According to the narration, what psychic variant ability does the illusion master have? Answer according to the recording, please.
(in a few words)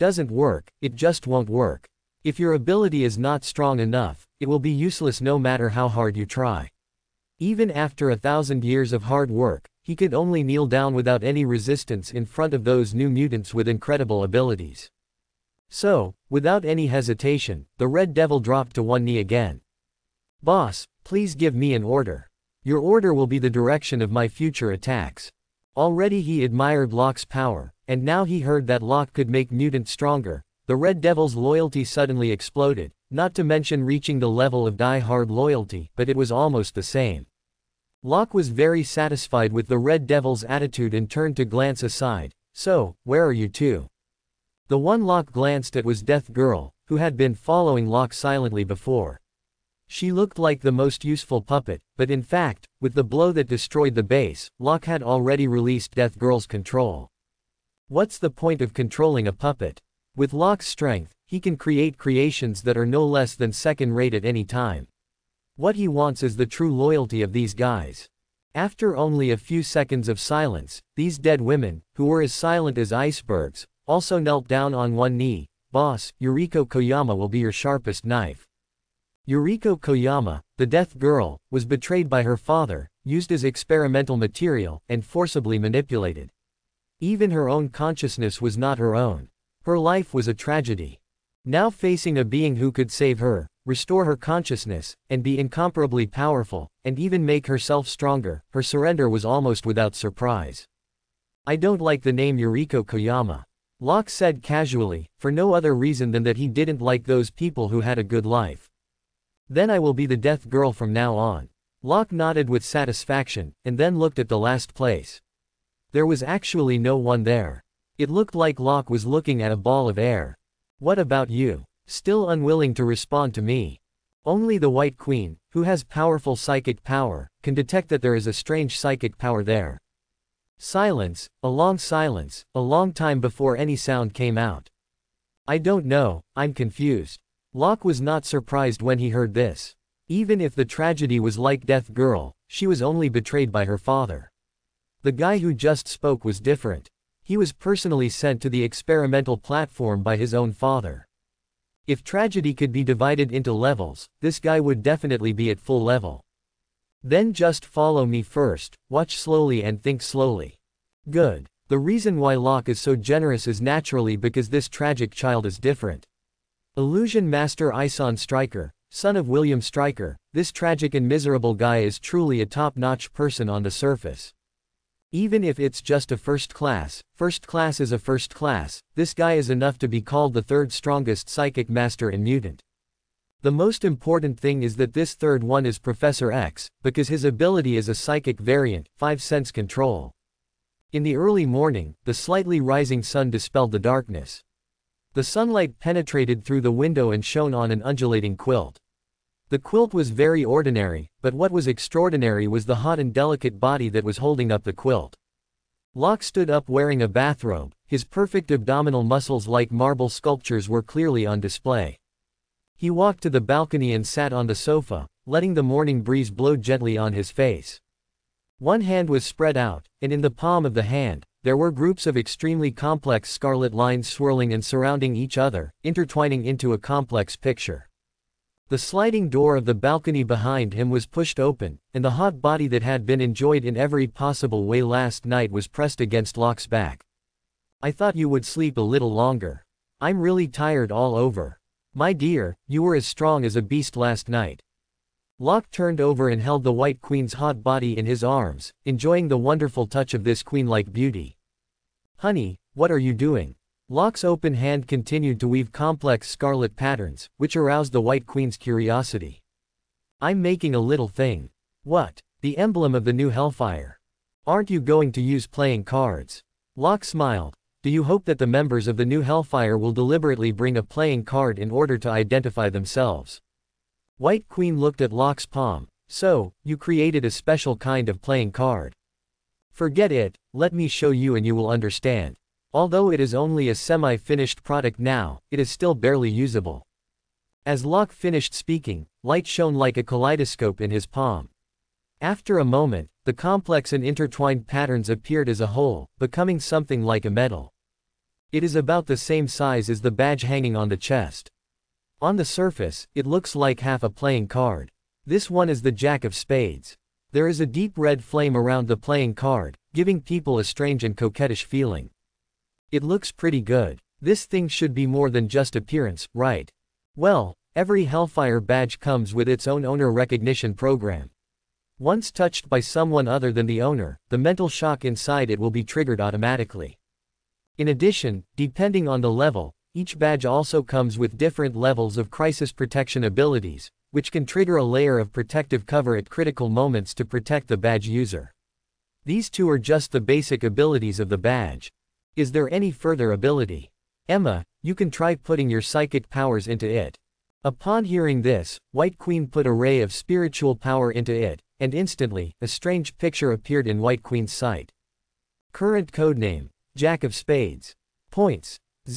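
5 sense control.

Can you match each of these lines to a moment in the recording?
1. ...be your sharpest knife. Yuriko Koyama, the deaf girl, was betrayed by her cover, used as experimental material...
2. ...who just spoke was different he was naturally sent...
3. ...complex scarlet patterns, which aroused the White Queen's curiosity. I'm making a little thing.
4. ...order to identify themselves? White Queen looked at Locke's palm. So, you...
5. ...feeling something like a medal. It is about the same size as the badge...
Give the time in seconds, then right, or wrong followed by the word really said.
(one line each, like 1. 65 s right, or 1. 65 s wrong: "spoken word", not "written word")
1. 77 s wrong: "father", not "cover"
2. 145 s wrong: "personally", not "naturally"
3. 255 s right
4. 271 s right
5. 296 s wrong: "becoming", not "feeling".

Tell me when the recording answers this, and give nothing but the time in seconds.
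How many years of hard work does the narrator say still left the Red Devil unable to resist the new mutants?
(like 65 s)
8 s.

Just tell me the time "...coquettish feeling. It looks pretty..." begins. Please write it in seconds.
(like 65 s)
311 s.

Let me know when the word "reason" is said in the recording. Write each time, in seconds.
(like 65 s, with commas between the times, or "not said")
105 s, 161 s.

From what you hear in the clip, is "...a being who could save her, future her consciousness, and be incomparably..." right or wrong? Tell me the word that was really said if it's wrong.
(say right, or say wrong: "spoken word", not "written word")
wrong: "restore", not "future".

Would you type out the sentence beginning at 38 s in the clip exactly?
Locke was very satisfied with the Red Devils' attitude and turned to glance aside, so, where are you two?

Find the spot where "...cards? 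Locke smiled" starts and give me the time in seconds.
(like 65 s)
265 s.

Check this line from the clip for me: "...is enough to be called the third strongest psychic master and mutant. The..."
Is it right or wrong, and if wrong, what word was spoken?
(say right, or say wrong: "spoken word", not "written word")
right.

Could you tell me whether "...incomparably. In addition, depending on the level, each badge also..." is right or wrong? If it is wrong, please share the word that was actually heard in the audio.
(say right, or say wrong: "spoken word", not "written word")
wrong: "automatically", not "incomparably".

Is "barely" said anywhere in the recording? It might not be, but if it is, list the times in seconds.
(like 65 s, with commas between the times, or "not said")
285 s.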